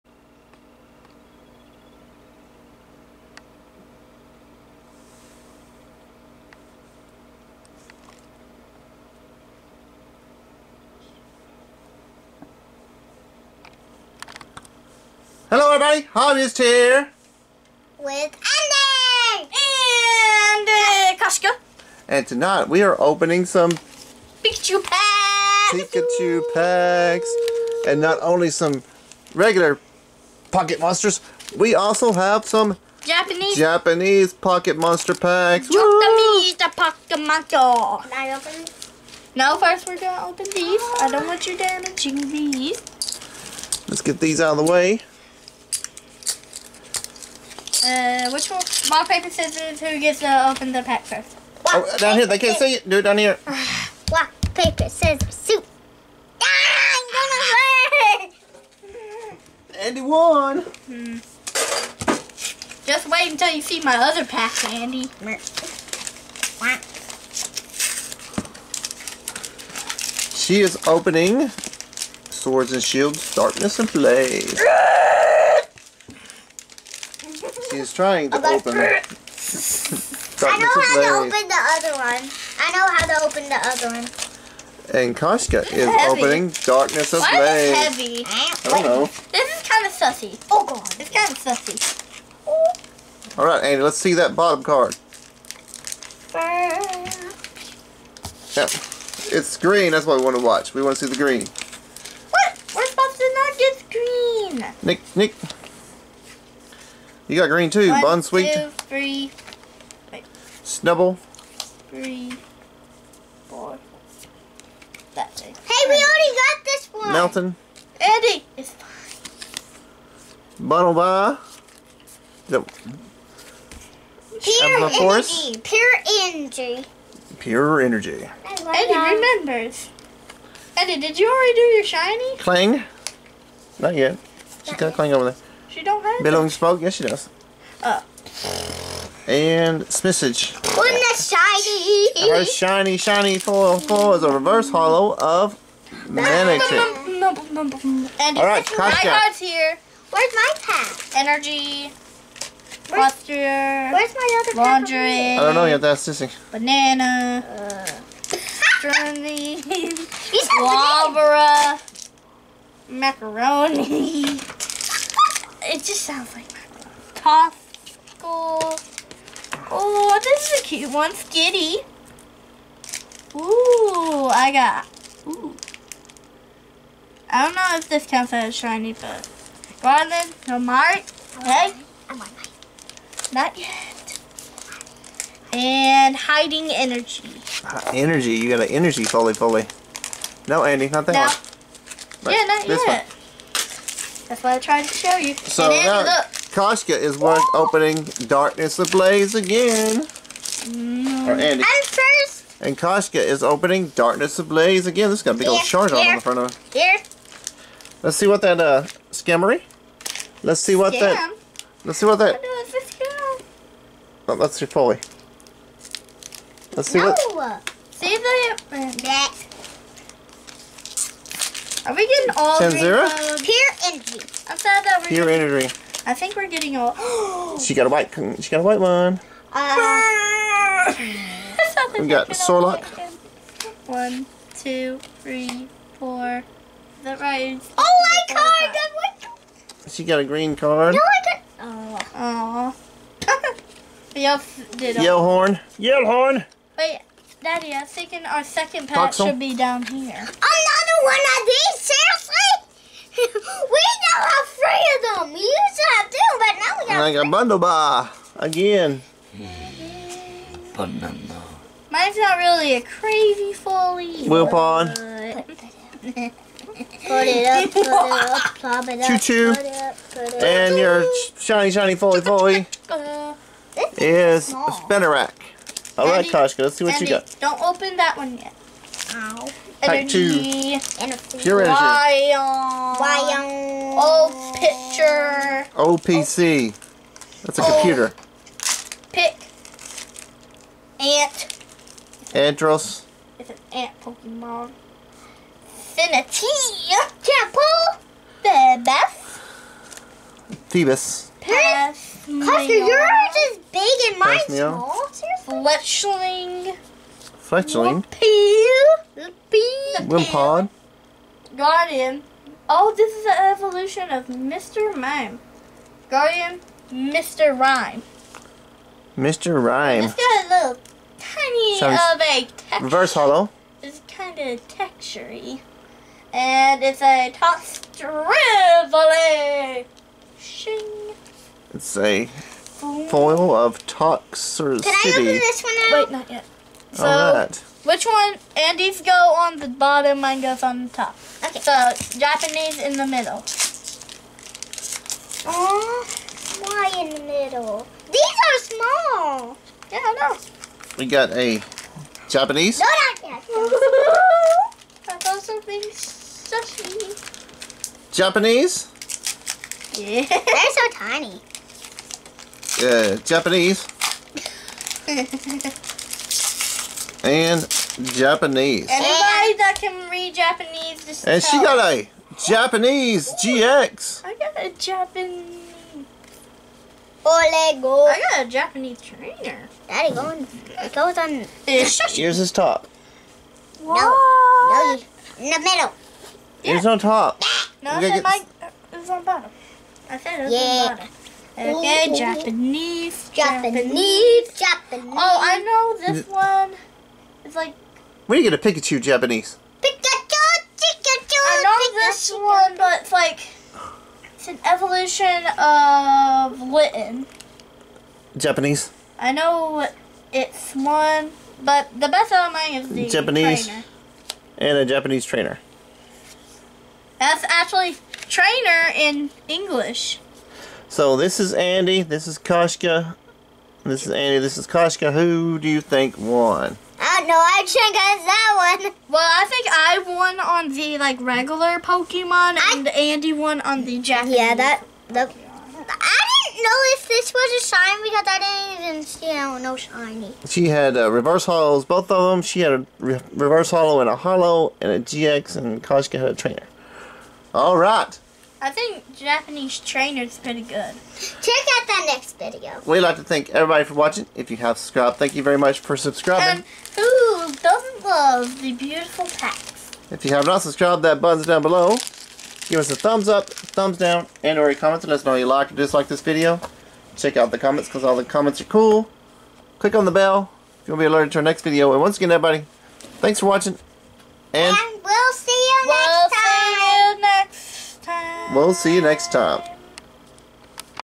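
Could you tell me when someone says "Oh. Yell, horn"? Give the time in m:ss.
4:02.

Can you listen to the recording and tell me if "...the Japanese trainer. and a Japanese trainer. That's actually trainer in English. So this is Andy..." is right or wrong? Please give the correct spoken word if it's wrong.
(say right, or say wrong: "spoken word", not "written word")
right.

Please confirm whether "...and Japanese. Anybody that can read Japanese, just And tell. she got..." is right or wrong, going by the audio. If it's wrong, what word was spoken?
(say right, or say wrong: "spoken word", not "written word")
right.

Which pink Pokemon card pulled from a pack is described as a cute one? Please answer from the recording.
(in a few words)
Skitty.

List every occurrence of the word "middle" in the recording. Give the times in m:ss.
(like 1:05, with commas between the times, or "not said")
5:43, 5:47, 6:25.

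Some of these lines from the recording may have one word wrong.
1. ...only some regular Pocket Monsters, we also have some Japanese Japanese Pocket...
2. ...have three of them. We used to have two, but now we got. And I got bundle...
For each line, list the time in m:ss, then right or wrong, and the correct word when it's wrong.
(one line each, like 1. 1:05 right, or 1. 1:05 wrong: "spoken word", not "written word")
1. 0:28 right
2. 4:14 right.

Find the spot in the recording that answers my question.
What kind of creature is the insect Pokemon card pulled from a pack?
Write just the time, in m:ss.
4:53.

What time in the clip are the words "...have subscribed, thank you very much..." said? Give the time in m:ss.
7:34.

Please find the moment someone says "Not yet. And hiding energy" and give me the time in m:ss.
3:03.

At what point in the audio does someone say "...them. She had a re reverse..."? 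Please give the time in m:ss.
7:22.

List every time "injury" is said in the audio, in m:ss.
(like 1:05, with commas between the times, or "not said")
not said.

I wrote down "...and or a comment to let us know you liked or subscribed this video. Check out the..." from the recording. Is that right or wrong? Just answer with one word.
wrong.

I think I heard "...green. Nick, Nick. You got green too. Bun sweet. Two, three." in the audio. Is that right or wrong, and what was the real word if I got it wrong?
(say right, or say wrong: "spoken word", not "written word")
right.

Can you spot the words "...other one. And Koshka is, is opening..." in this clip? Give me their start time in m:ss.
1:23.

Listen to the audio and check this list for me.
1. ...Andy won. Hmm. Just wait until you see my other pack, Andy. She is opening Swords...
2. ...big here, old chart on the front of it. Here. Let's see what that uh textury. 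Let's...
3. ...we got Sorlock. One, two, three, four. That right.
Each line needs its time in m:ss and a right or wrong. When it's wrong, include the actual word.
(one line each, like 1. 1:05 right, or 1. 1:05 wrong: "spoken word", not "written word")
1. 0:59 right
2. 3:25 wrong: "skimmery", not "textury"
3. 3:51 right.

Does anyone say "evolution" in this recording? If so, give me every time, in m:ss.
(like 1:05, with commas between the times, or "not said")
5:13, 6:44.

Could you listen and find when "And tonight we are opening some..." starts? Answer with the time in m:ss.
0:22.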